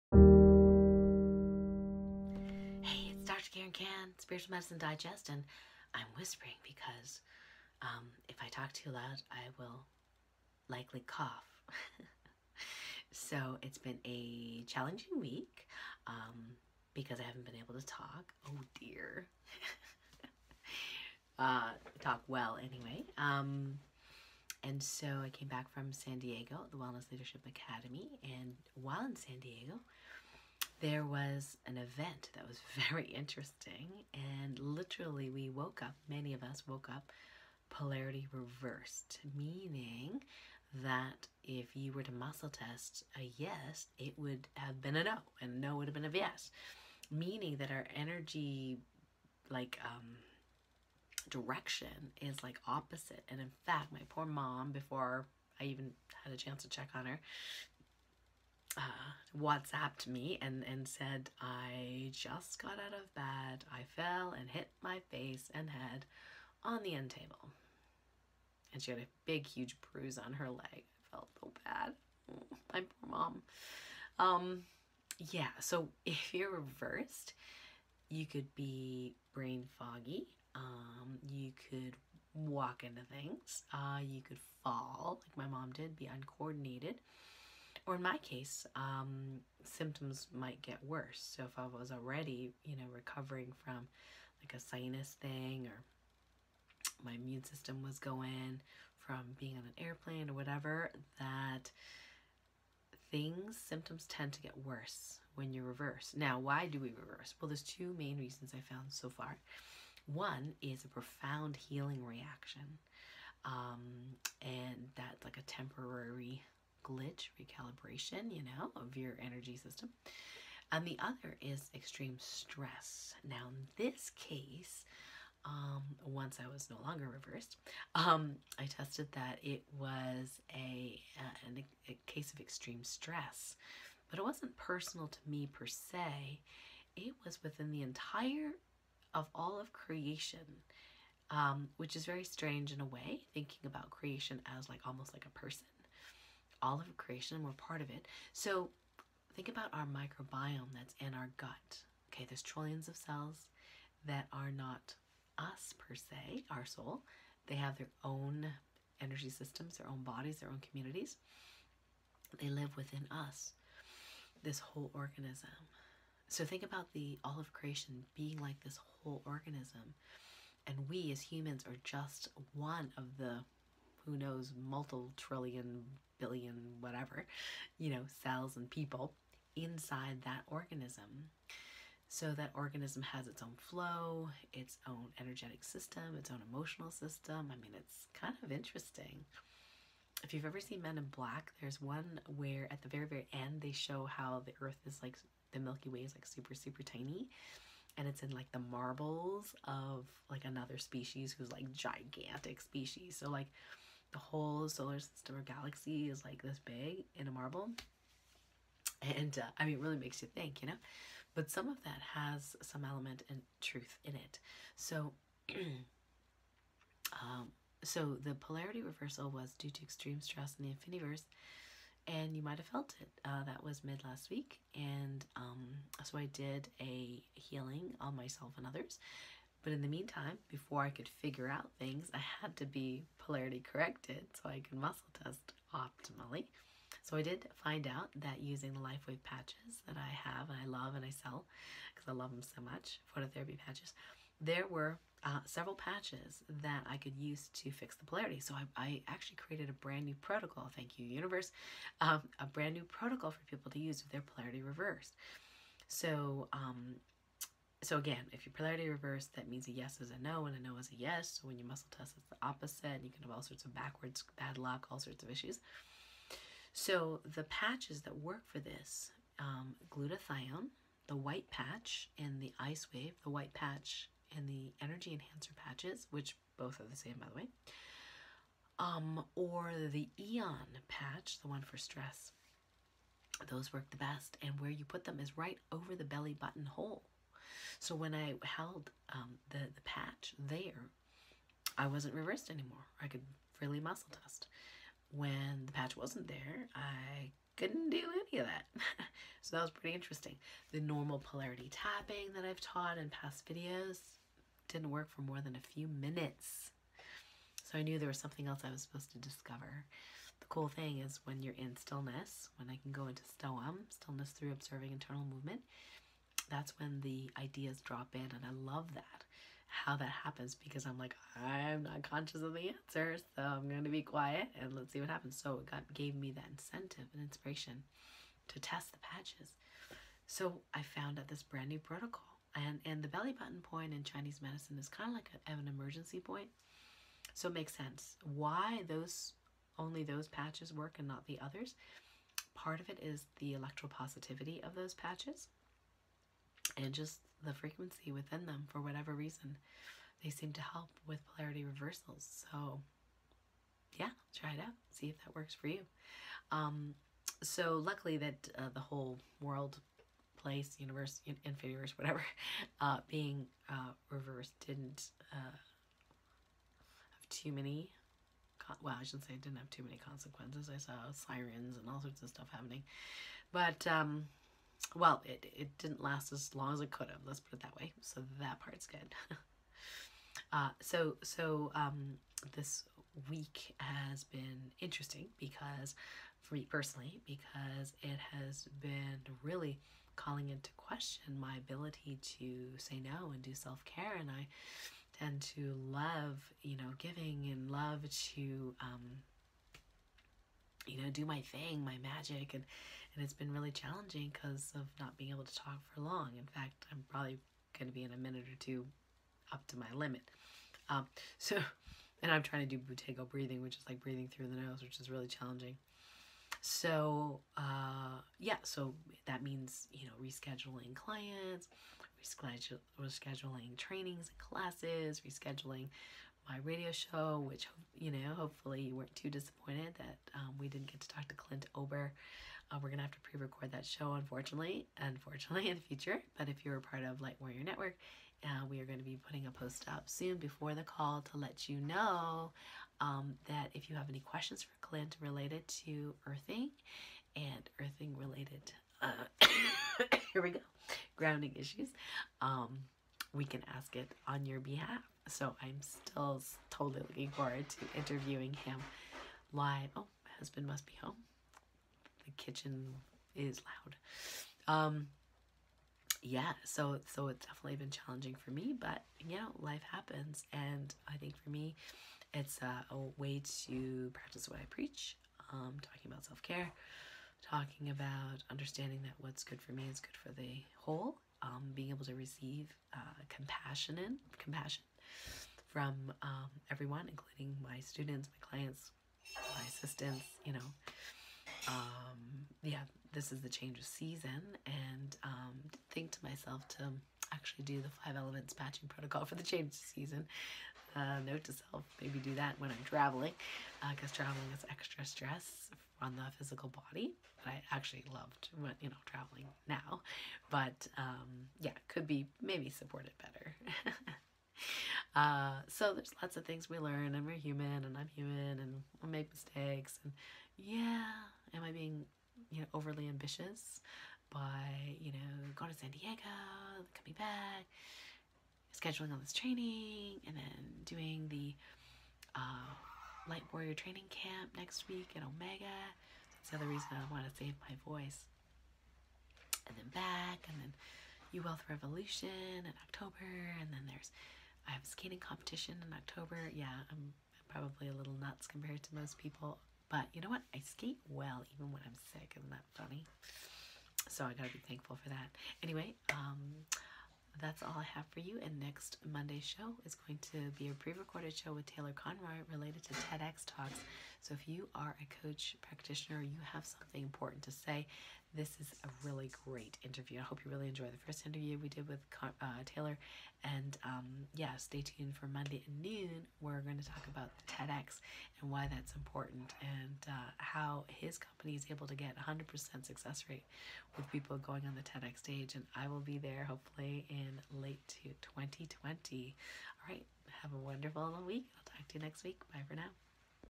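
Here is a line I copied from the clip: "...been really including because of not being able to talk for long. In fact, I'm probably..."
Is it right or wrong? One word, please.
wrong.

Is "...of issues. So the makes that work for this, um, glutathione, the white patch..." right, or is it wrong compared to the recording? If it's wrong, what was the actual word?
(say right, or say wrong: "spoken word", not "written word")
wrong: "patches", not "makes".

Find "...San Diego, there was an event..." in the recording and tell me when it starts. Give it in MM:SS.
00:29.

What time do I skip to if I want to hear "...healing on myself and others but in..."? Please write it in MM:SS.
03:47.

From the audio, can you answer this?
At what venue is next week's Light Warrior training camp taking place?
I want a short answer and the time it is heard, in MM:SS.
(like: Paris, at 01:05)
Omega, at 08:55.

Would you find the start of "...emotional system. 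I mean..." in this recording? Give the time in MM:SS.
03:06.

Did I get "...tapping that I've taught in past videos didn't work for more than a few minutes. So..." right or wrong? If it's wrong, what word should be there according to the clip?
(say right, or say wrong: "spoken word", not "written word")
right.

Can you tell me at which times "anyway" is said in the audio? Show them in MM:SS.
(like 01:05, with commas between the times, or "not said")
00:22, 09:15.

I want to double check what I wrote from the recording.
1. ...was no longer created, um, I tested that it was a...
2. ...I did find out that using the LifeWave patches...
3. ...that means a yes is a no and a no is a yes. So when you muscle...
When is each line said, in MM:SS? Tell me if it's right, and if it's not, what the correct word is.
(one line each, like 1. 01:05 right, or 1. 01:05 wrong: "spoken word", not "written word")
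1. 02:06 wrong: "reversed", not "created"
2. 03:57 right
3. 04:19 right.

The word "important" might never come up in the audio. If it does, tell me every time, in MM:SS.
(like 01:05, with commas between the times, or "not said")
09:27, 09:38.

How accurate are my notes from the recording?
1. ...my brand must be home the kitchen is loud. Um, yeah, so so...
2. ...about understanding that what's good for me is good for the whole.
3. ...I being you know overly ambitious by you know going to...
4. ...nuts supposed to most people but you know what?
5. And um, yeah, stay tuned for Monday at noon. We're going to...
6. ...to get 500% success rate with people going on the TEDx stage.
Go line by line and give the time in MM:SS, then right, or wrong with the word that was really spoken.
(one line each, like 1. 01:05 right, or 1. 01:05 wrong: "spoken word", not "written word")
1. 07:40 wrong: "husband", not "brand"
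2. 07:57 right
3. 08:41 right
4. 09:08 wrong: "compared", not "supposed"
5. 09:33 right
6. 09:41 wrong: "100", not "500".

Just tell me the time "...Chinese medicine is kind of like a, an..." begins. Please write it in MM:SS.
05:34.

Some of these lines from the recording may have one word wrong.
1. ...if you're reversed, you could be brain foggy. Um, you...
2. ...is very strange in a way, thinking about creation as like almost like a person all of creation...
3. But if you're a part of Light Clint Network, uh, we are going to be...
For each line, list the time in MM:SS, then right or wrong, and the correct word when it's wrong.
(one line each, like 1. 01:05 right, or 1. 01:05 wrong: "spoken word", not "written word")
1. 01:16 right
2. 02:21 right
3. 07:16 wrong: "Warrior", not "Clint".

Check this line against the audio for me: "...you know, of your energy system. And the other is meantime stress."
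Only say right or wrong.
wrong.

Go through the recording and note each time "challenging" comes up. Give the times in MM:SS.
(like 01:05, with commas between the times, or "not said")
00:14, 06:43, 06:55, 07:47.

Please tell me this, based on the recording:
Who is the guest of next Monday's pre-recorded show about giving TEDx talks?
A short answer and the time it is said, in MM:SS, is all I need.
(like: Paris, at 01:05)
Taylor Conroy, at 09:21.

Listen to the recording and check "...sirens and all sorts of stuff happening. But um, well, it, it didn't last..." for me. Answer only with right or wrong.
right.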